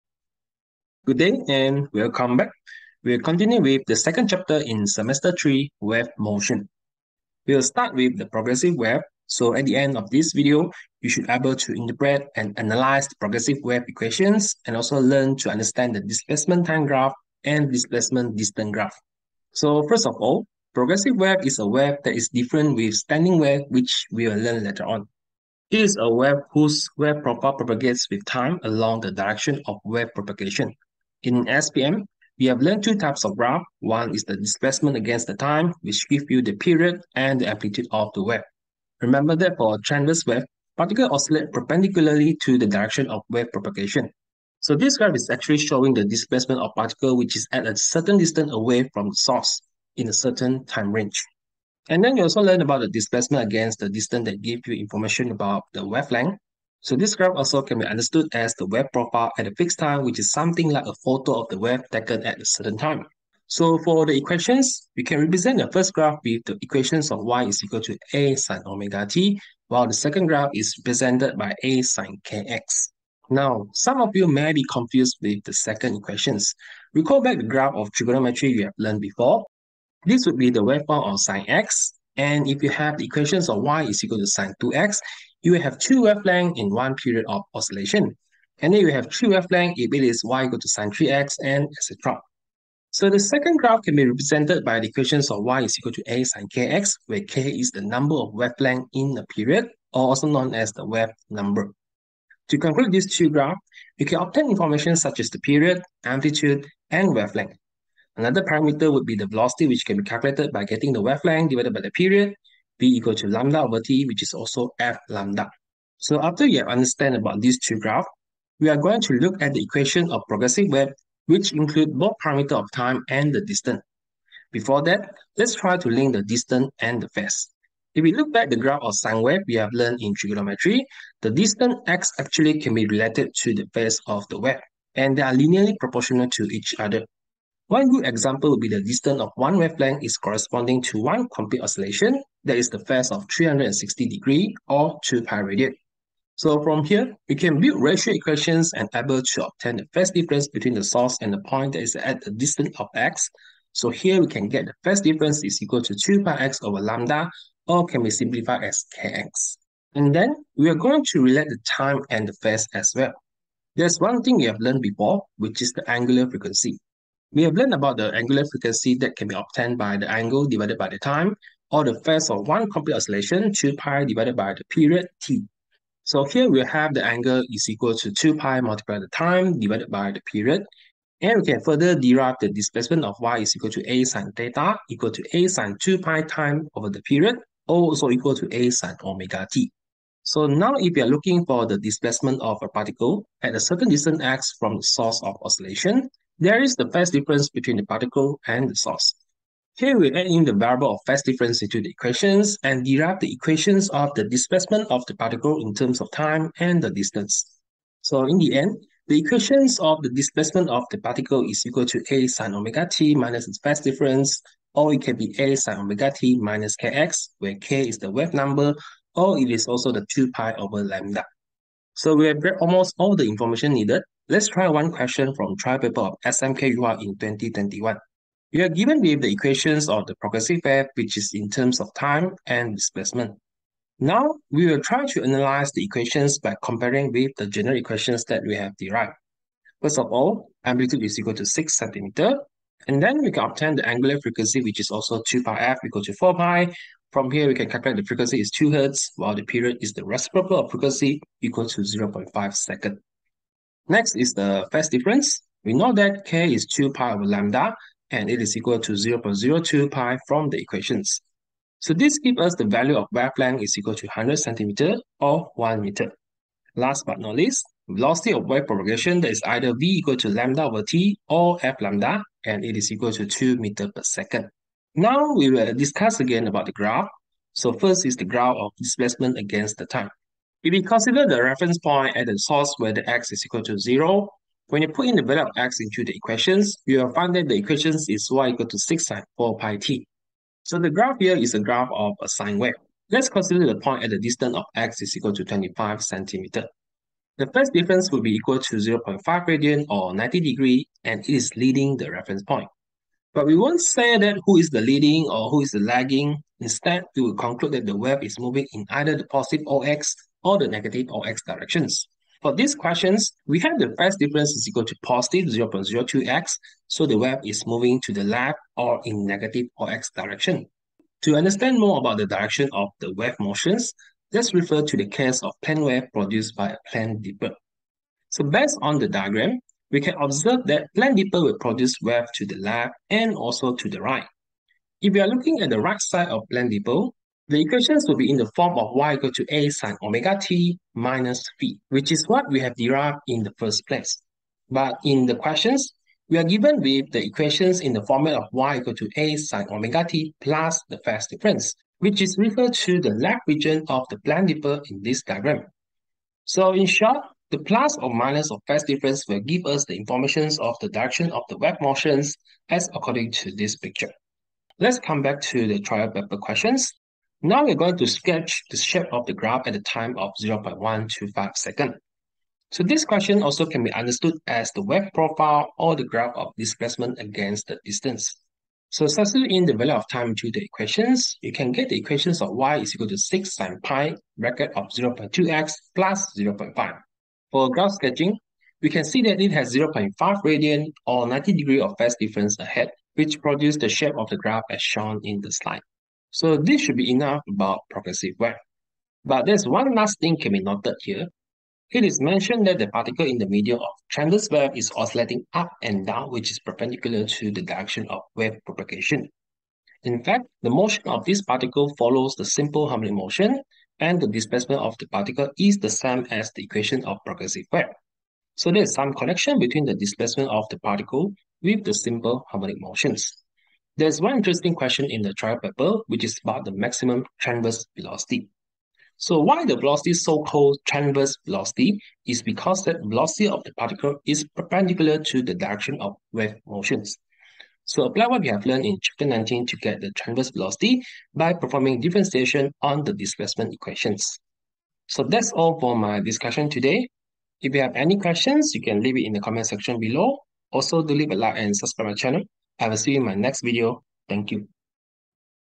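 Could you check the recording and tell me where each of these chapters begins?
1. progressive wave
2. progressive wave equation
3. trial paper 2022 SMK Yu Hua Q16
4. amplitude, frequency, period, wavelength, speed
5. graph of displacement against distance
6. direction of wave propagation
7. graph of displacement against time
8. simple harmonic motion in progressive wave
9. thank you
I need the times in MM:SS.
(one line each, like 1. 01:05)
1. 00:19
2. 01:55
3. 03:41
4. 04:00
5. 04:34
6. 05:21
7. 06:04
8. 06:36
9. 07:24.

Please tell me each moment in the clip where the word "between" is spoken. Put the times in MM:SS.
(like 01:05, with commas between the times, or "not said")
02:30, 03:17, 06:59.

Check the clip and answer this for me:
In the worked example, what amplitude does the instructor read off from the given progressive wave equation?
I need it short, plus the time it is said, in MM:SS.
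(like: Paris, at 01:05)
6 cm, at 04:01.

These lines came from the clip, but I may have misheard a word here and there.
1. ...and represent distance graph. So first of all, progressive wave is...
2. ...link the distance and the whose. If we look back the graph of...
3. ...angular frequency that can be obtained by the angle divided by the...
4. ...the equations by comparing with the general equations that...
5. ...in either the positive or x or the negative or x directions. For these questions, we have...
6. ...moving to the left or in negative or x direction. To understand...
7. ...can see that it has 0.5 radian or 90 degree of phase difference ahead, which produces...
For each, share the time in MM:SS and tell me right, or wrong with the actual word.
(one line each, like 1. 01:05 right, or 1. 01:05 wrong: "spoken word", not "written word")
1. 00:17 wrong: "displacement", not "represent"
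2. 02:05 wrong: "phase", not "whose"
3. 02:48 right
4. 03:55 right
5. 05:08 right
6. 05:17 right
7. 06:28 right.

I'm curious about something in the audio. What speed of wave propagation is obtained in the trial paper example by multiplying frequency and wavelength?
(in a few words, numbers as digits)
2 m/s.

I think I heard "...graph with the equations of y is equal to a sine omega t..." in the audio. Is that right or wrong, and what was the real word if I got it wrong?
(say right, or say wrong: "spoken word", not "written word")
right.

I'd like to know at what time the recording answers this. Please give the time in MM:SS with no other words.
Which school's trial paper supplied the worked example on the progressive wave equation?
03:46.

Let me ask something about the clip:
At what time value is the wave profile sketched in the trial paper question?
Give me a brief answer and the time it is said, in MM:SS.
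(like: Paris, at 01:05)
0.125 s, at 06:10.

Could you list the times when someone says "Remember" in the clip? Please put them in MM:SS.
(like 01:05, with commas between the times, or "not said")
00:39.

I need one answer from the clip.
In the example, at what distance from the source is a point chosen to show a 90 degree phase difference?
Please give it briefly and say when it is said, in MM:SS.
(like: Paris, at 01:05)
25 cm, at 04:55.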